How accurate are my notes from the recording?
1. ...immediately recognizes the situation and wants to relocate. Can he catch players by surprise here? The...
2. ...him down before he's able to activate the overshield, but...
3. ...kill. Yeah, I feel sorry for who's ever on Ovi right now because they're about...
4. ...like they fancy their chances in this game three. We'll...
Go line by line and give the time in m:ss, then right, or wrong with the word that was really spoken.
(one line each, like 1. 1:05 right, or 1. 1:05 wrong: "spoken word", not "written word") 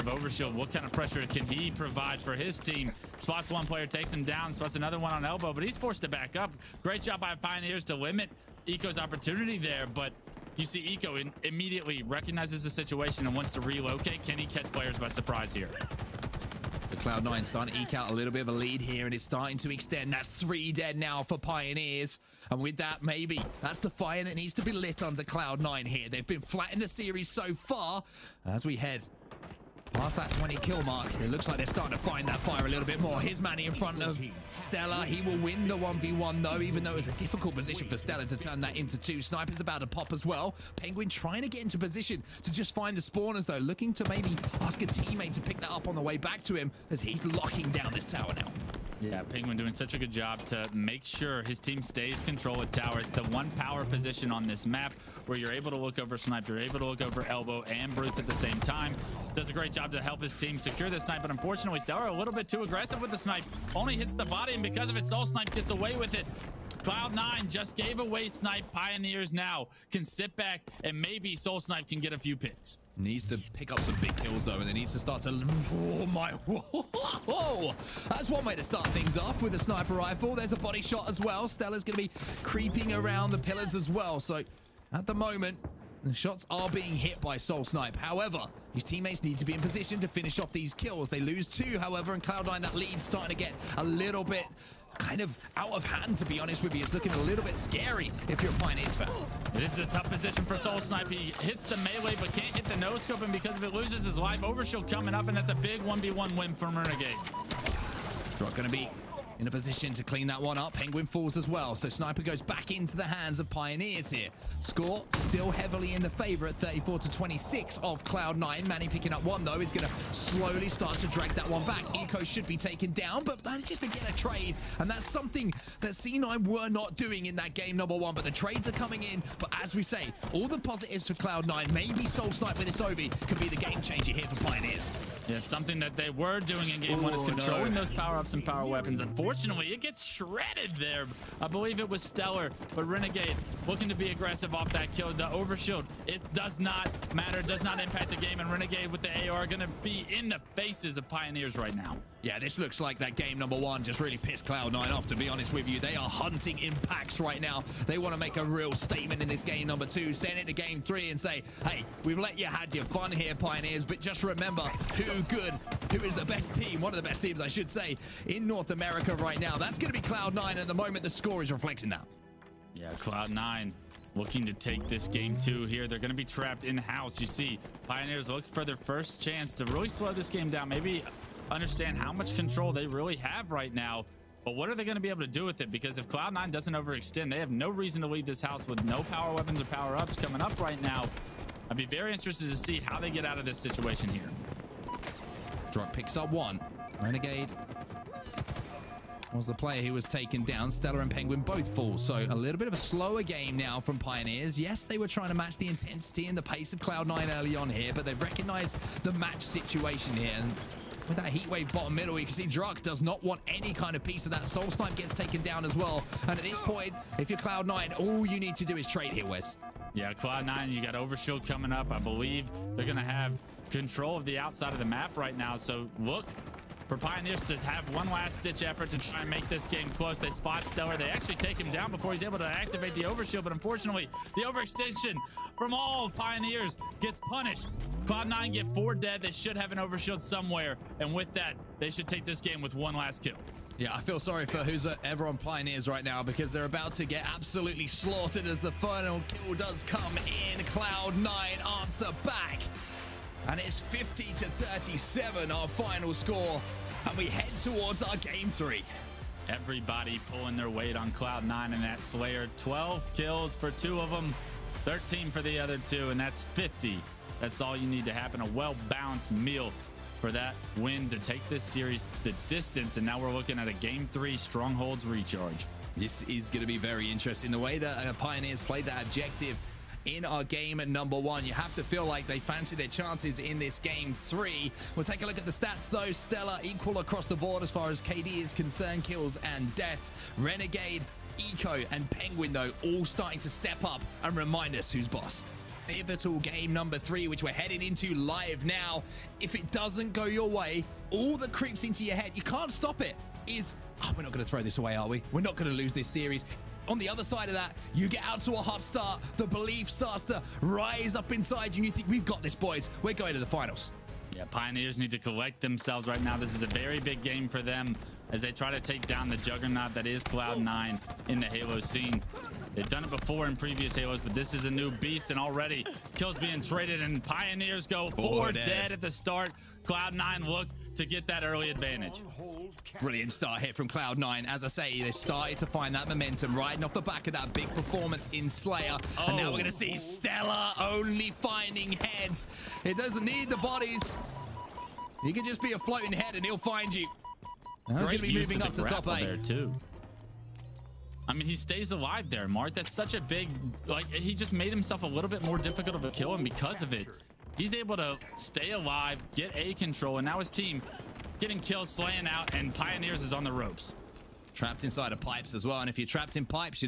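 1. 0:11 right
2. 3:51 right
3. 4:03 wrong: "Pioneers", not "Ovi"
4. 4:42 right.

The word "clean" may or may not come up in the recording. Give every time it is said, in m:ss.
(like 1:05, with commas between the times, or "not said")
1:50.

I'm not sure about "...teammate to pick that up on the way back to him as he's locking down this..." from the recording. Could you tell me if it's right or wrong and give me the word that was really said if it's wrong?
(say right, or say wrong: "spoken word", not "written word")
right.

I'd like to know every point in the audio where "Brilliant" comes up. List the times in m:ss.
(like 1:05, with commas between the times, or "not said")
5:33.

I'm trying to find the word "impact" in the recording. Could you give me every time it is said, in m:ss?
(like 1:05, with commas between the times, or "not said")
2:27, 2:36.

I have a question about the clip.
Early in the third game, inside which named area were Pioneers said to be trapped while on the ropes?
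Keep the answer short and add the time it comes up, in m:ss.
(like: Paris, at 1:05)
pipes, at 6:05.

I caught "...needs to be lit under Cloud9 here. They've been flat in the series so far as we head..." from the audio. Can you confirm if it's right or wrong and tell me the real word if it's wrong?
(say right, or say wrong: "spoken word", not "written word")
right.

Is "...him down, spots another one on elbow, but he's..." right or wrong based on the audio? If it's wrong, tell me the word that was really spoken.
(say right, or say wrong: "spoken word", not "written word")
right.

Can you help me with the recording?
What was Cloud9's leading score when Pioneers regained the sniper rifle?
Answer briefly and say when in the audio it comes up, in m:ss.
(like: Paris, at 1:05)
34 to 26, at 1:56.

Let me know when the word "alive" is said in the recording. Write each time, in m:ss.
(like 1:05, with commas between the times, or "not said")
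5:51, 5:58.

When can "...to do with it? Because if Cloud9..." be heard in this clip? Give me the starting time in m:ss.
3:05.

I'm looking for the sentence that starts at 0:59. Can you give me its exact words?
Does a great job to help his team secure this snipe, but unfortunately, StelluR a little bit too aggressive with the snipe.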